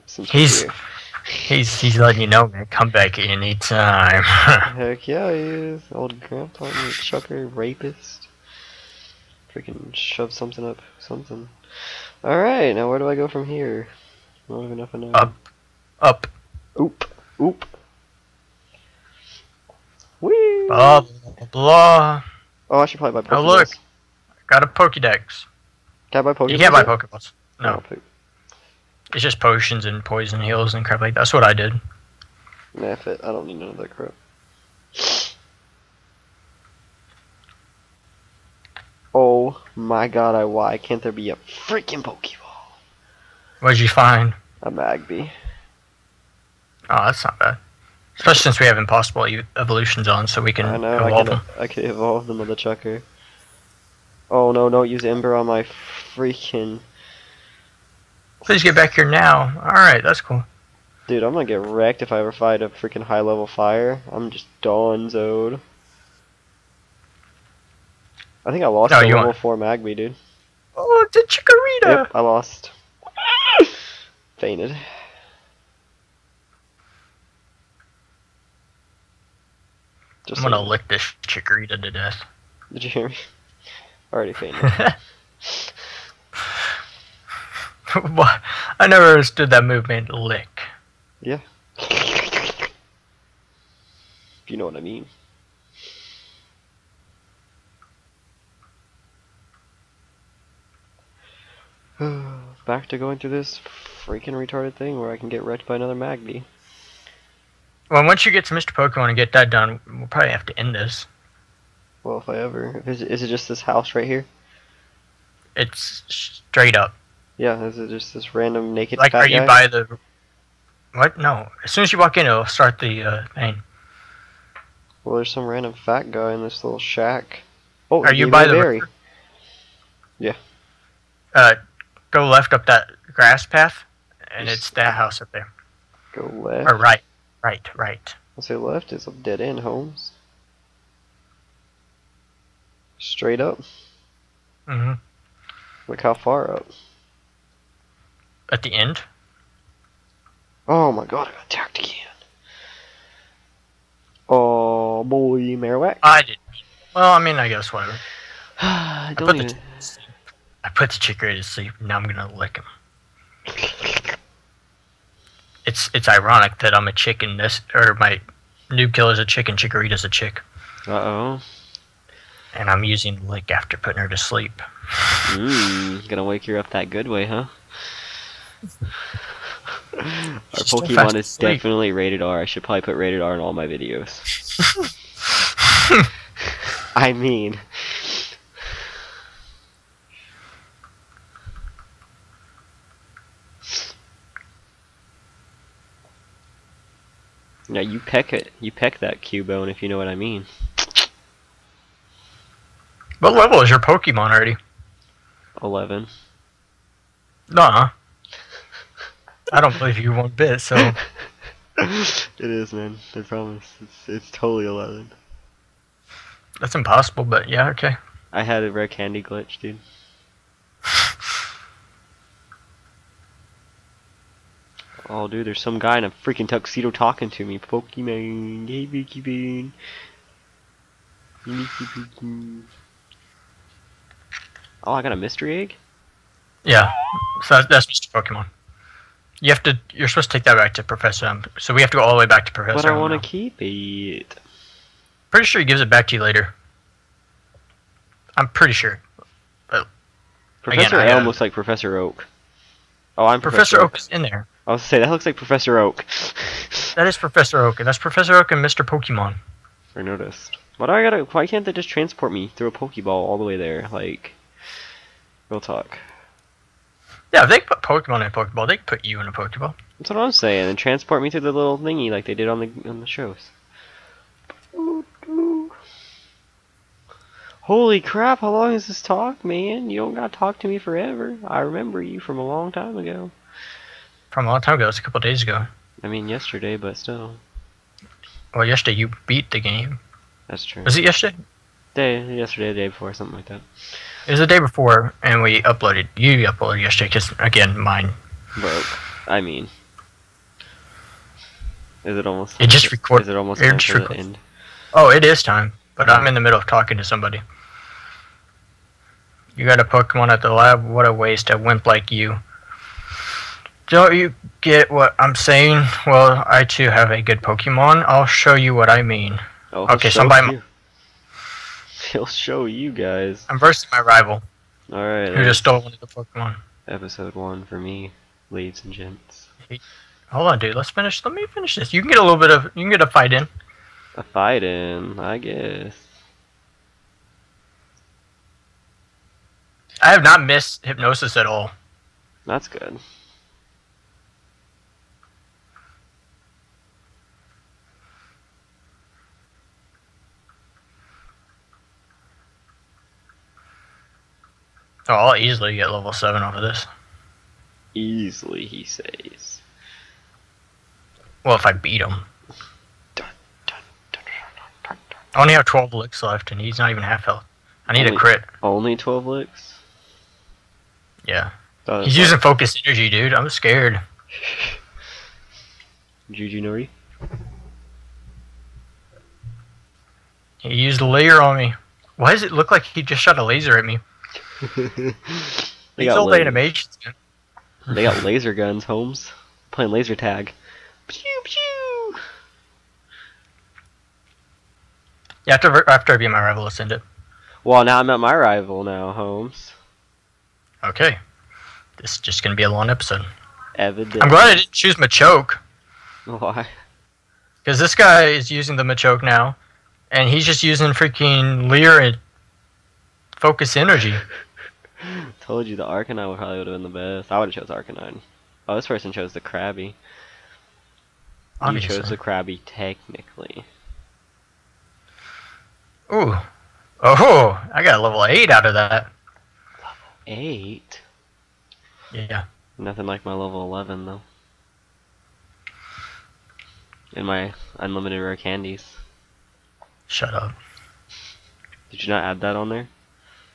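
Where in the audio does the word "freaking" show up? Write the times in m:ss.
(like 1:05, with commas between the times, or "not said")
0:09, 0:41, 0:56, 1:02, 1:44, 3:46, 6:50.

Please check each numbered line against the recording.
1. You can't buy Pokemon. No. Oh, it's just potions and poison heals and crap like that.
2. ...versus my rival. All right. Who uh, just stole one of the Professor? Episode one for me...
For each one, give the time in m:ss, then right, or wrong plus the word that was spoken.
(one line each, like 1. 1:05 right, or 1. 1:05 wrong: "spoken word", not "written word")
1. 0:26 right
2. 5:23 wrong: "Pokemon", not "Professor".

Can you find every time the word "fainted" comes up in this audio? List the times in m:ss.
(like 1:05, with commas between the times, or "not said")
1:14, 1:24.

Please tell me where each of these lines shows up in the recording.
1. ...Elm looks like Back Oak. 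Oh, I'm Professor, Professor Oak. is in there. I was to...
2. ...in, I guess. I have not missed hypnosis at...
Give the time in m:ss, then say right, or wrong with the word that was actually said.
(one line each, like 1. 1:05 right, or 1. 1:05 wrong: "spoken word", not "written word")
1. 4:11 wrong: "Professor", not "Back"
2. 5:34 right.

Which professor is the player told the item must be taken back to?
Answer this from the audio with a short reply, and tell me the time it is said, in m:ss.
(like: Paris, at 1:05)
Professor Elm, at 4:00.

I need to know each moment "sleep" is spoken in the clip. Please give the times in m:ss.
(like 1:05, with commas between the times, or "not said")
2:41, 2:54.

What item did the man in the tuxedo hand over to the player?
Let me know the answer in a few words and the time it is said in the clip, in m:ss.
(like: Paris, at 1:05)
Mystery egg, at 3:55.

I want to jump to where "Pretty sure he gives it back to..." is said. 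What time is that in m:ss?
4:05.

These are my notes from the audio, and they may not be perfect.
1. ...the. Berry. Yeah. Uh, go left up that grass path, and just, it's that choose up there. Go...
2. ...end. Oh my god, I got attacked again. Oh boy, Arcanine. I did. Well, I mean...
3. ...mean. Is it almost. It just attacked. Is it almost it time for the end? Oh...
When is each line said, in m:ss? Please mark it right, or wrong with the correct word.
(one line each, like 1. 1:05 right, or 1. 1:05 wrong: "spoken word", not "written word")
1. 2:08 wrong: "house", not "choose"
2. 2:28 wrong: "Marowak", not "Arcanine"
3. 4:59 wrong: "recorded", not "attacked".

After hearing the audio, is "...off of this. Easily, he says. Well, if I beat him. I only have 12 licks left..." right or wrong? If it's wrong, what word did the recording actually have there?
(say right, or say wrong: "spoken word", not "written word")
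right.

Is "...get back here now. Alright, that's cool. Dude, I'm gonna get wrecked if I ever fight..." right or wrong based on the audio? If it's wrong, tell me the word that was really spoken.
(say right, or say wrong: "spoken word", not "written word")
right.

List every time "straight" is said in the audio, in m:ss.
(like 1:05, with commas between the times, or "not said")
1:56, 2:22.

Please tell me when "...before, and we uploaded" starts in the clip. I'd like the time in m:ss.
4:54.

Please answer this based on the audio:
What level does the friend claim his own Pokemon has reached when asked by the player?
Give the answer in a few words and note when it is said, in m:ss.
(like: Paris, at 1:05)
11, at 3:25.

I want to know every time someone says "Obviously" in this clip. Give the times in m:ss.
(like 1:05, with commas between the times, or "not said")
7:01.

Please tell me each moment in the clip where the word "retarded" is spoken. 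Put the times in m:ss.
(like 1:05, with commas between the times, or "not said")
1:44.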